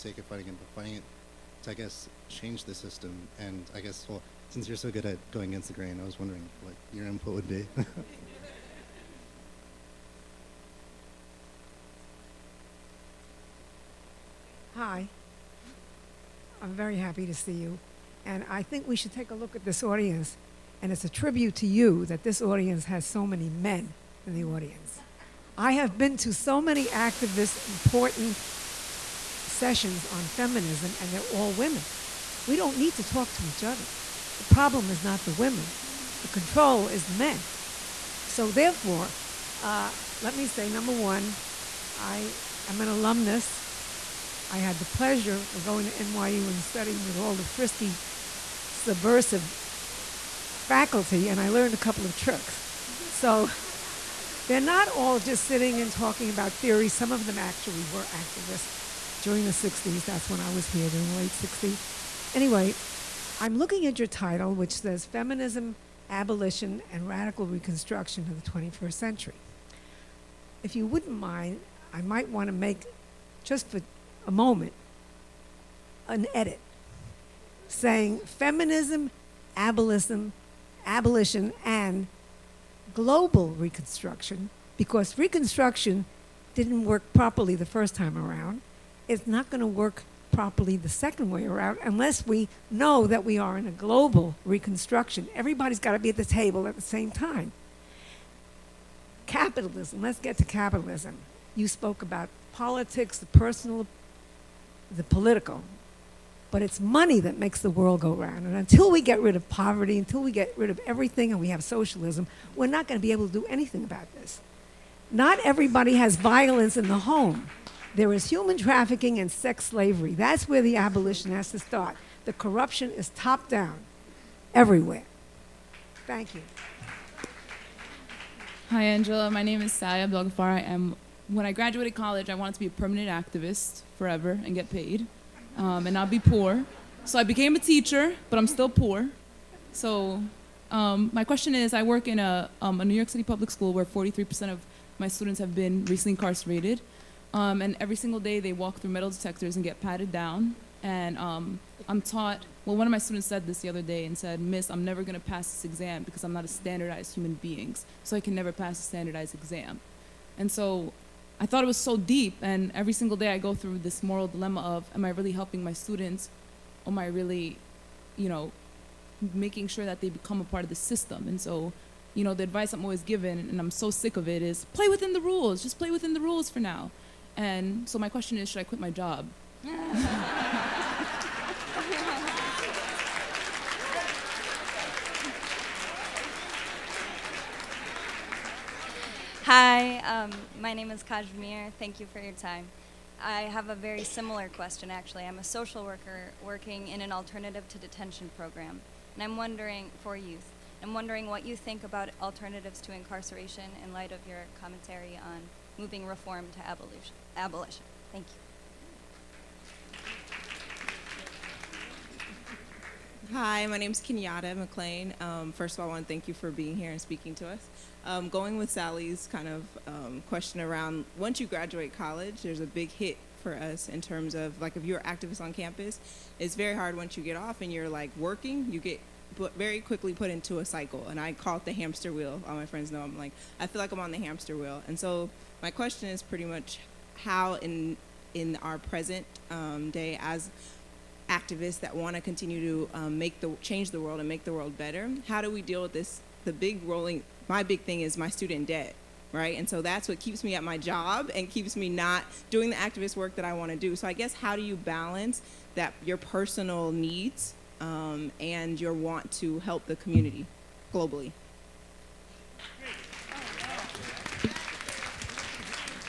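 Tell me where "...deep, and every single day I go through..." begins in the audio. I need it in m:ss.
2:41.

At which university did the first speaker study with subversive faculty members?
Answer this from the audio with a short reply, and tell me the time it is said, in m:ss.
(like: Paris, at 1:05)
NYU, at 0:45.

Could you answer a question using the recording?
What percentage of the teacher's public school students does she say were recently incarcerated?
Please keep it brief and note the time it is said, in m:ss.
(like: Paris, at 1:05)
43%, at 2:23.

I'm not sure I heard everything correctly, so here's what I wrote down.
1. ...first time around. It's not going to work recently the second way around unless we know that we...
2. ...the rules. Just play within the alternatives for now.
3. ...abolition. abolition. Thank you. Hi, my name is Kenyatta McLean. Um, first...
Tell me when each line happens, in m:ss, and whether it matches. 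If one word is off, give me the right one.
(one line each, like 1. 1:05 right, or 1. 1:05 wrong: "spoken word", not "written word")
1. 1:27 wrong: "properly", not "recently"
2. 2:55 wrong: "rules", not "alternatives"
3. 3:26 right.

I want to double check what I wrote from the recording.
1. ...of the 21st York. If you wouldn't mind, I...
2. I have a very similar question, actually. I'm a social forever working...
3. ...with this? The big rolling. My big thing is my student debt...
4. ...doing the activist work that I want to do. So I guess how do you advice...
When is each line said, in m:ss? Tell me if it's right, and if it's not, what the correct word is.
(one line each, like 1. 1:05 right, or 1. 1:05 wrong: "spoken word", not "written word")
1. 1:08 wrong: "Century", not "York"
2. 3:13 wrong: "worker", not "forever"
3. 4:05 right
4. 4:12 wrong: "balance", not "advice".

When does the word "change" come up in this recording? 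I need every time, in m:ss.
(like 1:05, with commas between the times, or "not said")
0:02, 4:03.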